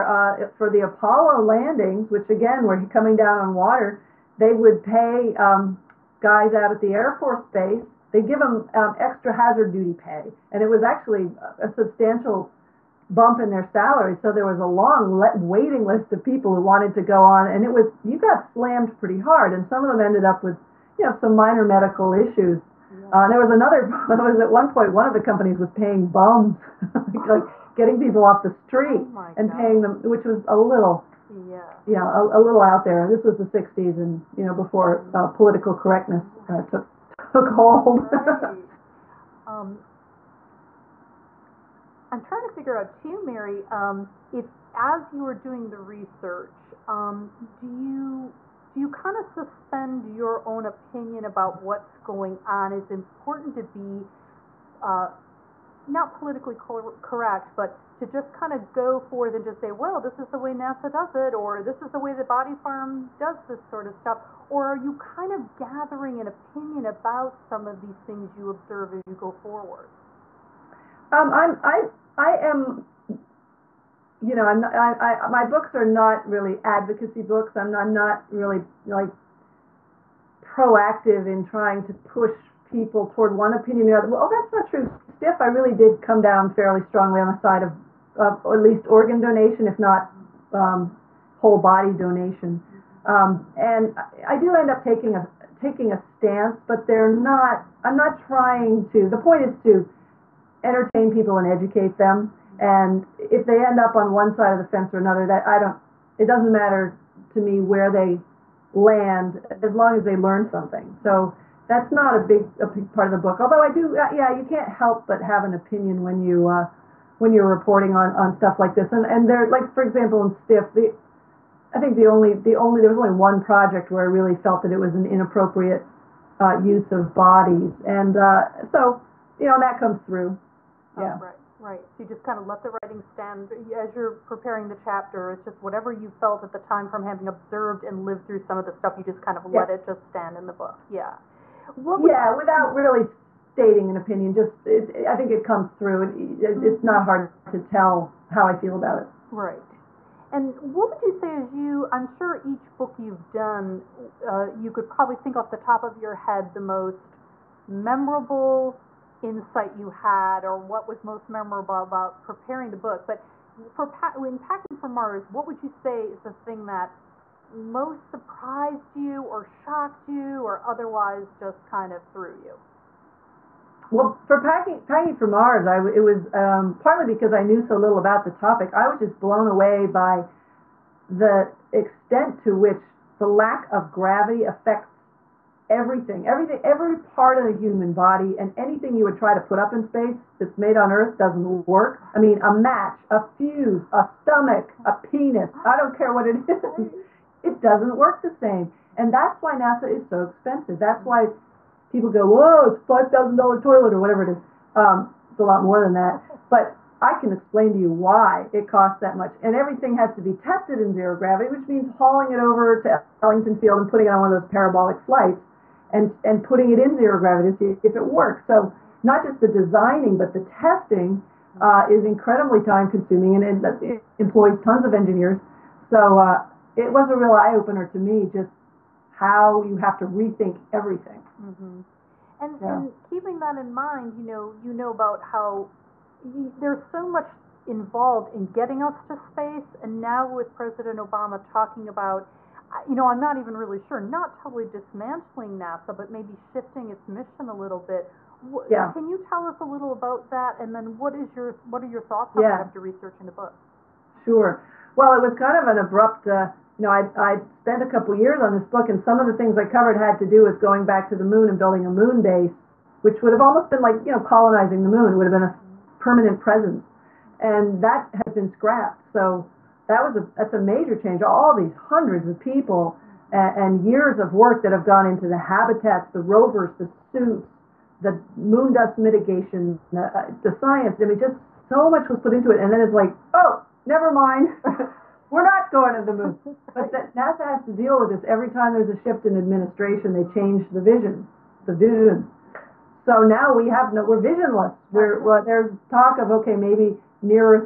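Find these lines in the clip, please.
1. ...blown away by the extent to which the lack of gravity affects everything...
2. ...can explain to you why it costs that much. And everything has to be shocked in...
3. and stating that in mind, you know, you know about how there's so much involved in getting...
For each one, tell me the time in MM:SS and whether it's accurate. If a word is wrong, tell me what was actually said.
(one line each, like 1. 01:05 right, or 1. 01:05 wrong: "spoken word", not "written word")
1. 02:59 right
2. 03:27 wrong: "tested", not "shocked"
3. 03:52 wrong: "keeping", not "stating".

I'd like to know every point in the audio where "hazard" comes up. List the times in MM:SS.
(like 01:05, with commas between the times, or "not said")
00:09.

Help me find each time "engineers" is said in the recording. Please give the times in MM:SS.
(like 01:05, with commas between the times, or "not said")
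03:44.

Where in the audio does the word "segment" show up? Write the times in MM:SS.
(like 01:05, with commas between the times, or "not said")
not said.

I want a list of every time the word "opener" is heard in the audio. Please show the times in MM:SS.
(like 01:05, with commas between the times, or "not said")
03:47.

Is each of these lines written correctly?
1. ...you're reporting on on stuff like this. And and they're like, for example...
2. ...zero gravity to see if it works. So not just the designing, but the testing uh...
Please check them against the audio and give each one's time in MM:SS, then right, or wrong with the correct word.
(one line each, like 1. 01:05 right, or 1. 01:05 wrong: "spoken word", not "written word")
1. 01:57 right
2. 03:36 right.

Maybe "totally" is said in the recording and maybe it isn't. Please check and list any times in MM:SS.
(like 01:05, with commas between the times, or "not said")
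04:04.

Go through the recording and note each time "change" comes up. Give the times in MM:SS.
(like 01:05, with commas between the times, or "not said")
04:30, 04:50.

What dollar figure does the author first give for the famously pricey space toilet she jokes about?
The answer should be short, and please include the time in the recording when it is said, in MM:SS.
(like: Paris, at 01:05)
$5,000, at 03:22.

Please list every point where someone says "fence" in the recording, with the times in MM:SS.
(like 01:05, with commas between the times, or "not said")
01:44.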